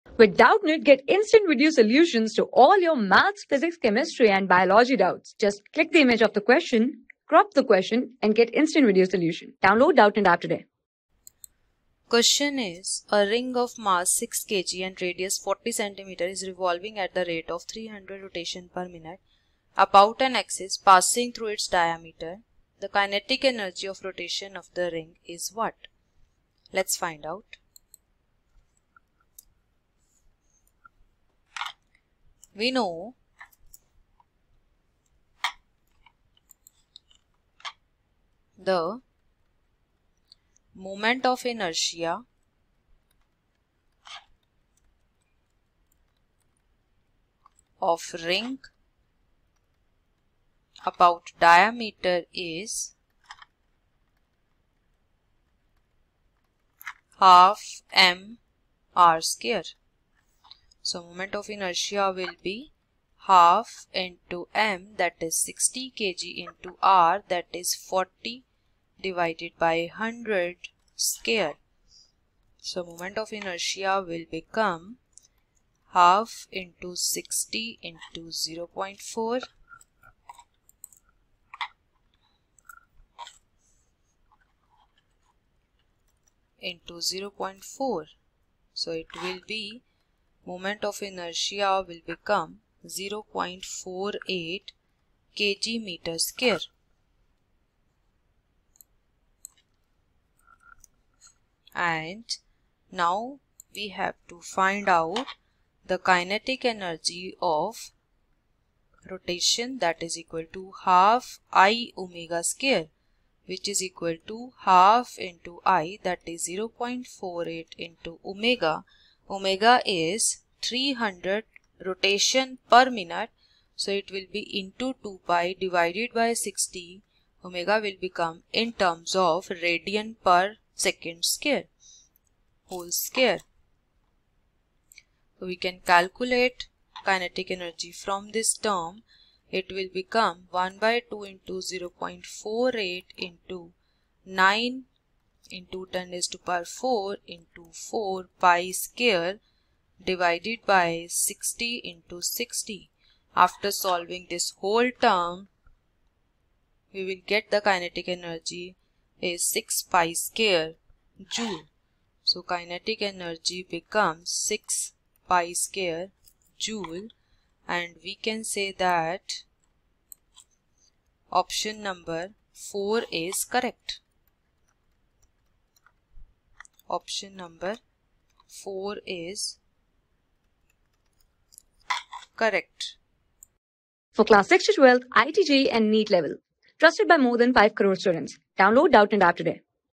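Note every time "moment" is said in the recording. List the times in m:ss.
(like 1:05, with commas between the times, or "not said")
0:40, 1:01, 1:12, 1:30.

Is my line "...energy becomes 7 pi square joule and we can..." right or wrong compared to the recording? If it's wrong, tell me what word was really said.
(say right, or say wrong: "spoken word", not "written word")
wrong: "6", not "7".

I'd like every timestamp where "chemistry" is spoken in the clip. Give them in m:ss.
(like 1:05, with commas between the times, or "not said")
0:03.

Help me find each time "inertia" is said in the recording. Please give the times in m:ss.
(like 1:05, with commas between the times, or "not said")
0:41, 1:01, 1:13, 1:31.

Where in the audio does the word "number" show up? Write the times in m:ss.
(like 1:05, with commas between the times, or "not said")
2:51, 2:57.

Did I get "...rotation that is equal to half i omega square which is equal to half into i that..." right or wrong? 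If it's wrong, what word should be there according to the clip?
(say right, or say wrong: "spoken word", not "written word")
right.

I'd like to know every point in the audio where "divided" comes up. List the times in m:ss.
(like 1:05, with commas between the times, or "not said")
1:08, 2:05, 2:30.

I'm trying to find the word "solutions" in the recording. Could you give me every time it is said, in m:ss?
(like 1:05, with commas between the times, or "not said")
0:01, 0:09.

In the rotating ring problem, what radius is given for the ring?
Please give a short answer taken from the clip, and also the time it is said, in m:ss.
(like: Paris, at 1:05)
40 cm, at 0:15.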